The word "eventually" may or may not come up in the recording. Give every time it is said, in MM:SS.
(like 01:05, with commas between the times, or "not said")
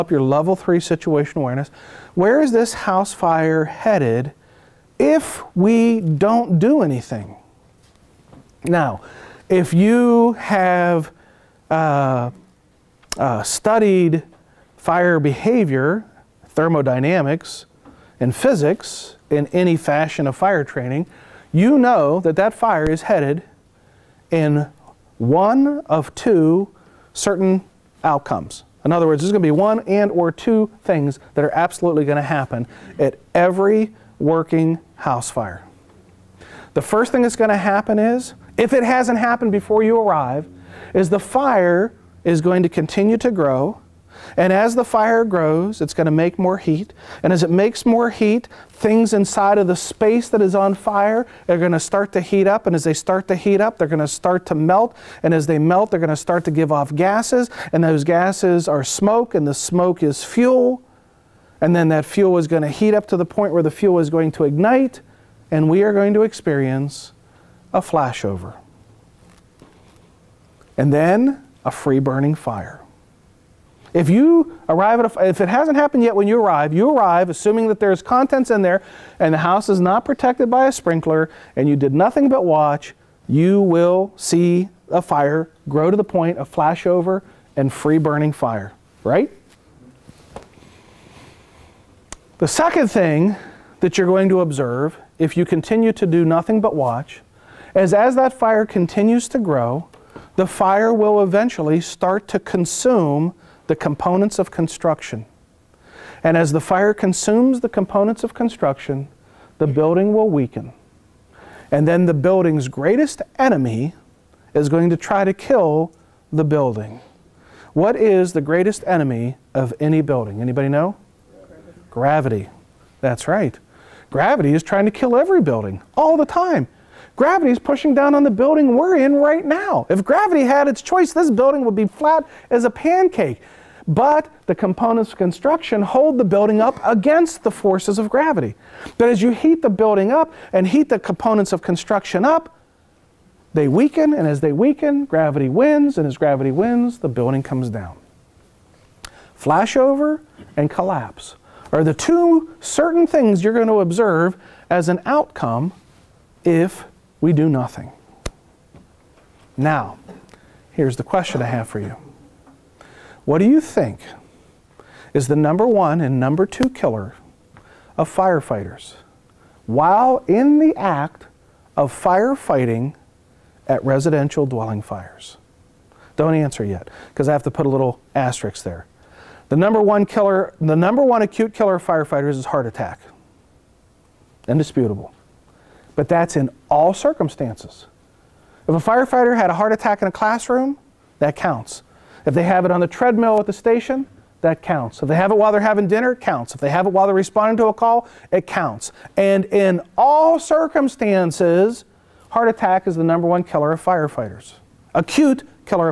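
01:41.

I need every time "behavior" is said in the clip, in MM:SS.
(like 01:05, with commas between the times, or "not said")
00:15.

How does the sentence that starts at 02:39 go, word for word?
Now, here's the question I have for you.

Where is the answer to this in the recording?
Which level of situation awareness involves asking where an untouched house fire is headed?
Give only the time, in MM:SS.
00:00.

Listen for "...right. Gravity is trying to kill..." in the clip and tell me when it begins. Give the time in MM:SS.
02:03.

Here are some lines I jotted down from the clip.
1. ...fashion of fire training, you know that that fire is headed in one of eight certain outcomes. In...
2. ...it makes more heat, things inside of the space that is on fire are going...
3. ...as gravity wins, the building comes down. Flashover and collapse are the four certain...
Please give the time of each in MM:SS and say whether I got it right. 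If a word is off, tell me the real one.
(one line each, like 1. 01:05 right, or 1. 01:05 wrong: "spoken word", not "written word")
1. 00:19 wrong: "two", not "eight"
2. 00:47 right
3. 02:26 wrong: "two", not "four".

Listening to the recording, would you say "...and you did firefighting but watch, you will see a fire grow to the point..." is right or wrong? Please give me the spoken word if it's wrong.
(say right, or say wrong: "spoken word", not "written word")
wrong: "nothing", not "firefighting".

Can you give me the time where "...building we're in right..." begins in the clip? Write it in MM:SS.
02:08.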